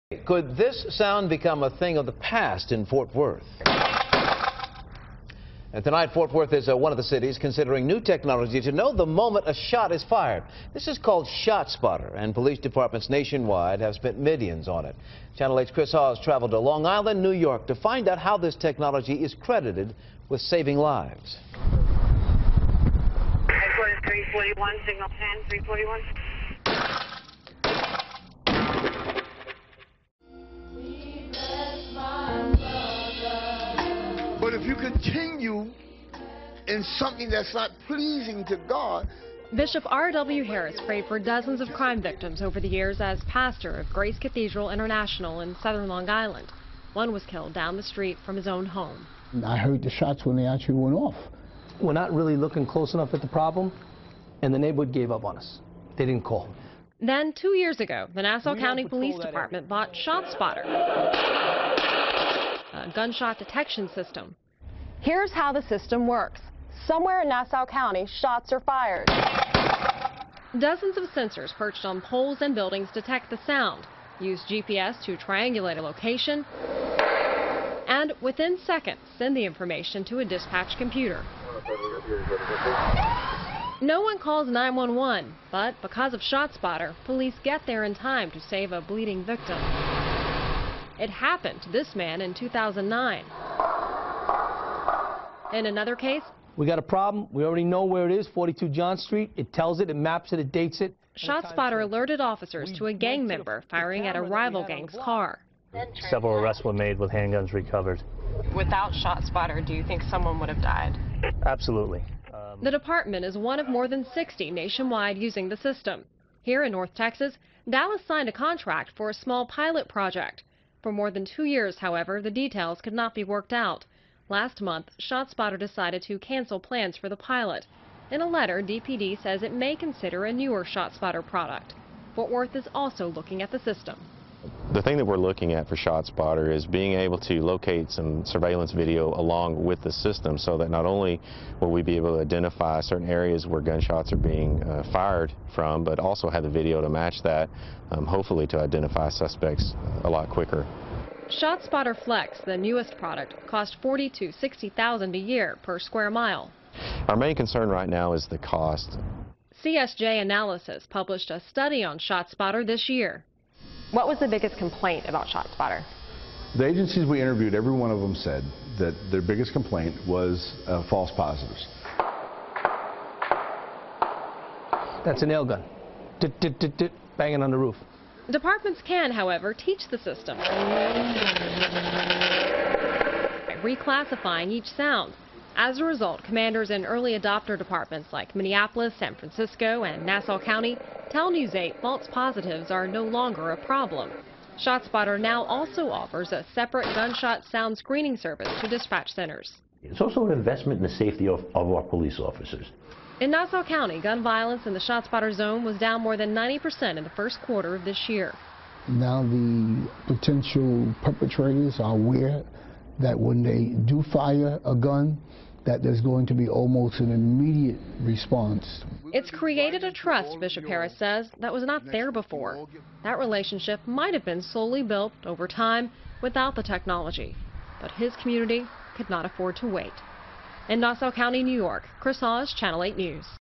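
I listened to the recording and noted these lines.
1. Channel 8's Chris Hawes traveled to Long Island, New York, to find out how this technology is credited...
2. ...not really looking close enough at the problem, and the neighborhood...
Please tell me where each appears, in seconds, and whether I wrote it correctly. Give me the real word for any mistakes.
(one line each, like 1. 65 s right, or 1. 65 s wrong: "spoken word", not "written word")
1. 15 s right
2. 51 s right.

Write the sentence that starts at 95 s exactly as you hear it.
In another case, we got a problem.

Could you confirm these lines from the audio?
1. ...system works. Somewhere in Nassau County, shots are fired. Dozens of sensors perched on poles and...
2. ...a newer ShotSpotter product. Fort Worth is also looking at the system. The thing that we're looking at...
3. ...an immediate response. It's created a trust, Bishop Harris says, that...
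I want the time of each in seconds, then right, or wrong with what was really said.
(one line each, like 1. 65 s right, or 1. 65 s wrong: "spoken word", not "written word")
1. 65 s right
2. 130 s right
3. 216 s right.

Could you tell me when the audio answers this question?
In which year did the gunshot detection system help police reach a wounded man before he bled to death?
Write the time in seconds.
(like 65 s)
92 s.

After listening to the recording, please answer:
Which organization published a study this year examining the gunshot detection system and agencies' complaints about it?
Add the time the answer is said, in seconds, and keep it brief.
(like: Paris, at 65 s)
CSJ Analysis, at 159 s.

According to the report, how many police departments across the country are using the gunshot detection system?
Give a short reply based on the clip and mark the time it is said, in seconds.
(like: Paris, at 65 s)
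more than 60, at 113 s.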